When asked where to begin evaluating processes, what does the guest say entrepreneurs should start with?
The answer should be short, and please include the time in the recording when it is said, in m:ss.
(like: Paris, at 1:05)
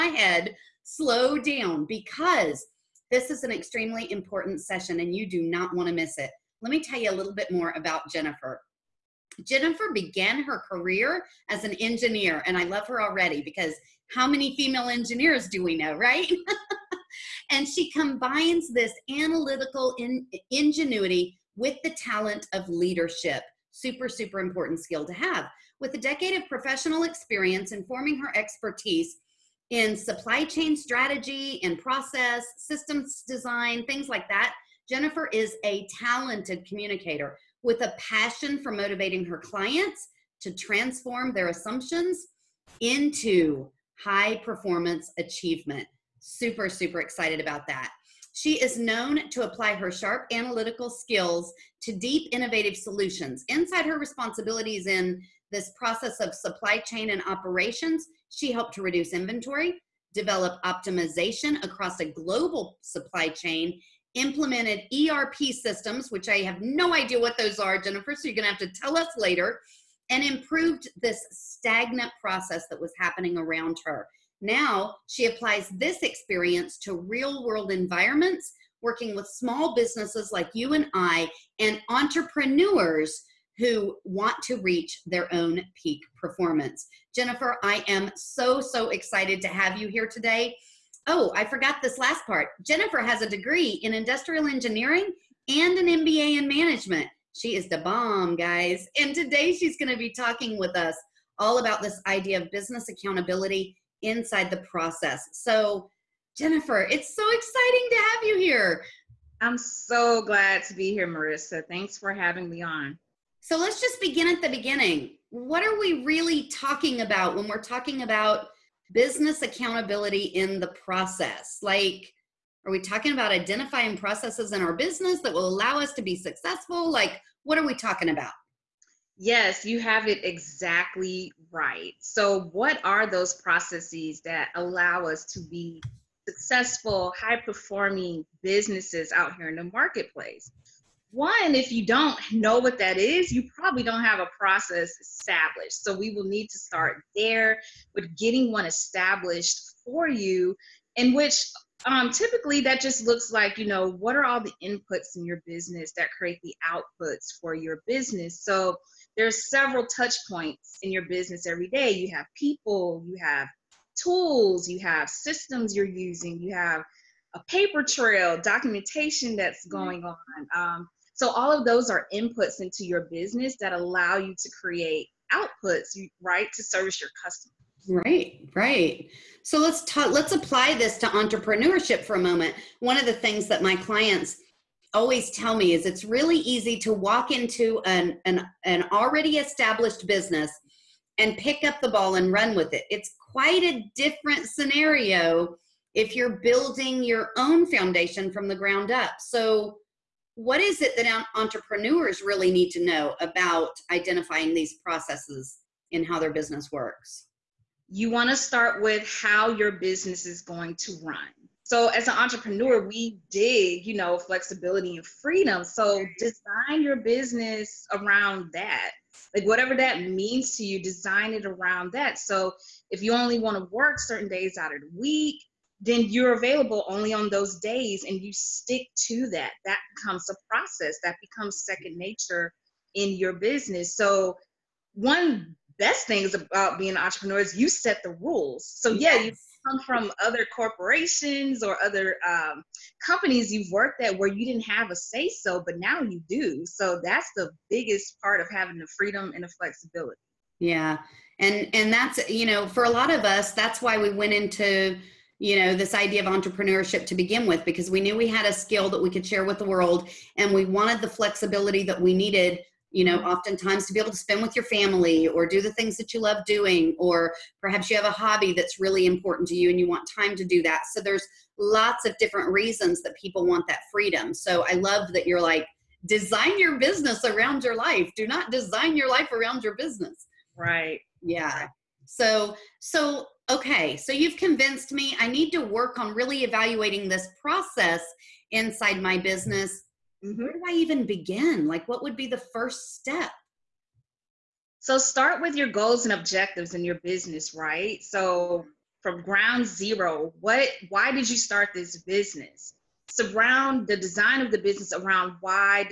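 goals and objectives, at 4:55.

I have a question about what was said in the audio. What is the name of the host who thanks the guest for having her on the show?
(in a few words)
Marissa.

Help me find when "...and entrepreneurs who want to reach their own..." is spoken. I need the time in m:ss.
1:21.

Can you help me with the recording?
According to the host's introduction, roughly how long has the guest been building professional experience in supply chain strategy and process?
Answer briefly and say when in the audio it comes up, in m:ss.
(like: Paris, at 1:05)
a decade, at 0:25.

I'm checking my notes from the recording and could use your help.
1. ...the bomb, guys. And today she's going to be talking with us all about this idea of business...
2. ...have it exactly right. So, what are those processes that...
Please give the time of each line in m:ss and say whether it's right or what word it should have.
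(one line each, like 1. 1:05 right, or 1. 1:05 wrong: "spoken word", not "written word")
1. 1:37 right
2. 2:09 right.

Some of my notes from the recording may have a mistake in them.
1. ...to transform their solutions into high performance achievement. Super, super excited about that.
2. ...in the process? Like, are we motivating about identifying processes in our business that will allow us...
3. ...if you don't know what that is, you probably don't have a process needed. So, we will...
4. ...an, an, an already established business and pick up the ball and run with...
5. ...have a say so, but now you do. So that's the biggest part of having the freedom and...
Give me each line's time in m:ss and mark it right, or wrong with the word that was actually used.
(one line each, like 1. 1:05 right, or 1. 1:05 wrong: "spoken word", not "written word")
1. 0:40 wrong: "assumptions", not "solutions"
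2. 2:00 wrong: "talking", not "motivating"
3. 2:21 wrong: "established", not "needed"
4. 3:07 right
5. 4:04 right.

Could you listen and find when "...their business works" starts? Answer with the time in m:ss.
3:26.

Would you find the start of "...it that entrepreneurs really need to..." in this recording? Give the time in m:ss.
3:20.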